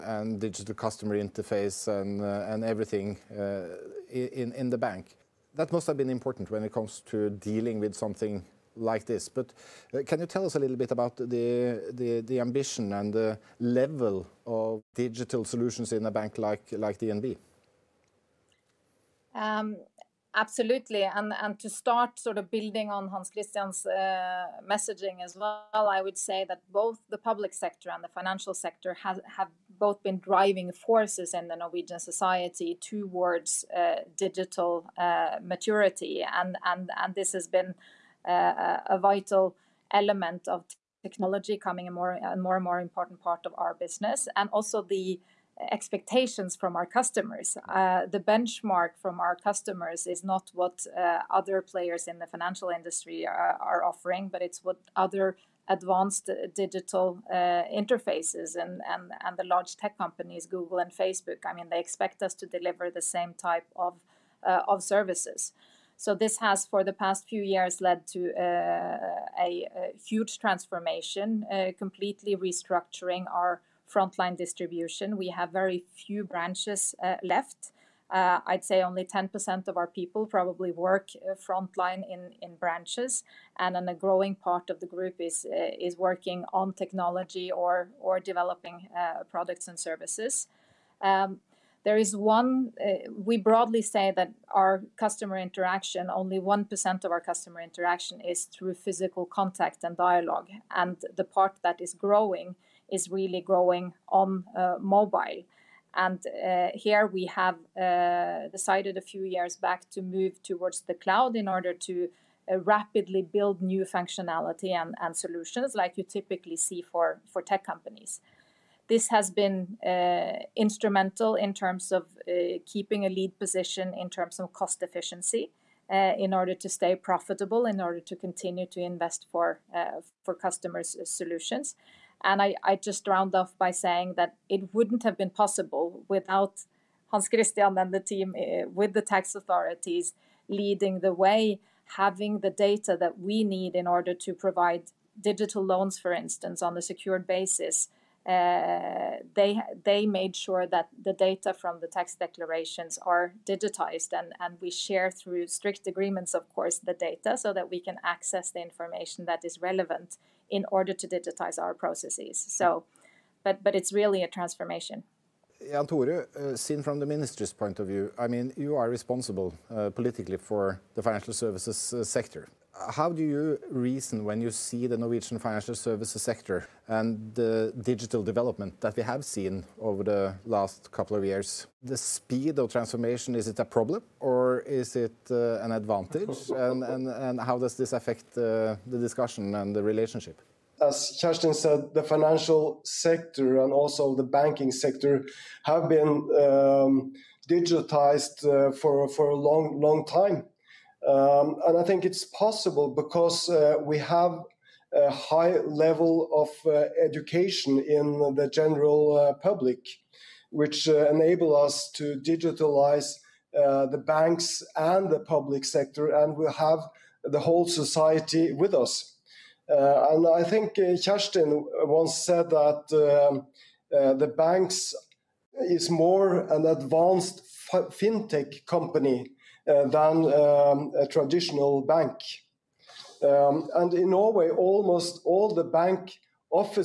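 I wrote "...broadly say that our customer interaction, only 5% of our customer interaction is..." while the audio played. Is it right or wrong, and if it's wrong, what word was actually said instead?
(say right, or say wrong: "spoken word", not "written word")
wrong: "1", not "5".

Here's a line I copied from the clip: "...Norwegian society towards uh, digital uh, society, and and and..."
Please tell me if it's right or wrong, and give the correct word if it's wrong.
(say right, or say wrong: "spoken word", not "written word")
wrong: "maturity", not "society".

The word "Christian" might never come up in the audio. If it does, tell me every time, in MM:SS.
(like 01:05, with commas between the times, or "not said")
00:23, 02:17.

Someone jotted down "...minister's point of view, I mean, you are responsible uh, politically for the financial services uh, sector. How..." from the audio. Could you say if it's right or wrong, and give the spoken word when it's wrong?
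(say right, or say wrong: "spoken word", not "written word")
right.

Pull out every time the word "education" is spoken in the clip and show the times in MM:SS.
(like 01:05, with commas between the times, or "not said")
03:27.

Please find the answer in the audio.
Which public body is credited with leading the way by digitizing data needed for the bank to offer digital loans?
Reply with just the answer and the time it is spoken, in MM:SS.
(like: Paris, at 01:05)
the tax authorities, at 02:18.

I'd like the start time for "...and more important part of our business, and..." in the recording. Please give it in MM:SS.
00:42.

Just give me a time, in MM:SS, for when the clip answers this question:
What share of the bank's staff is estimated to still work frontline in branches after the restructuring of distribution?
01:19.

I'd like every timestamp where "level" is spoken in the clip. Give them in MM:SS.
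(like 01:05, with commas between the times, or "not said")
00:13, 03:25.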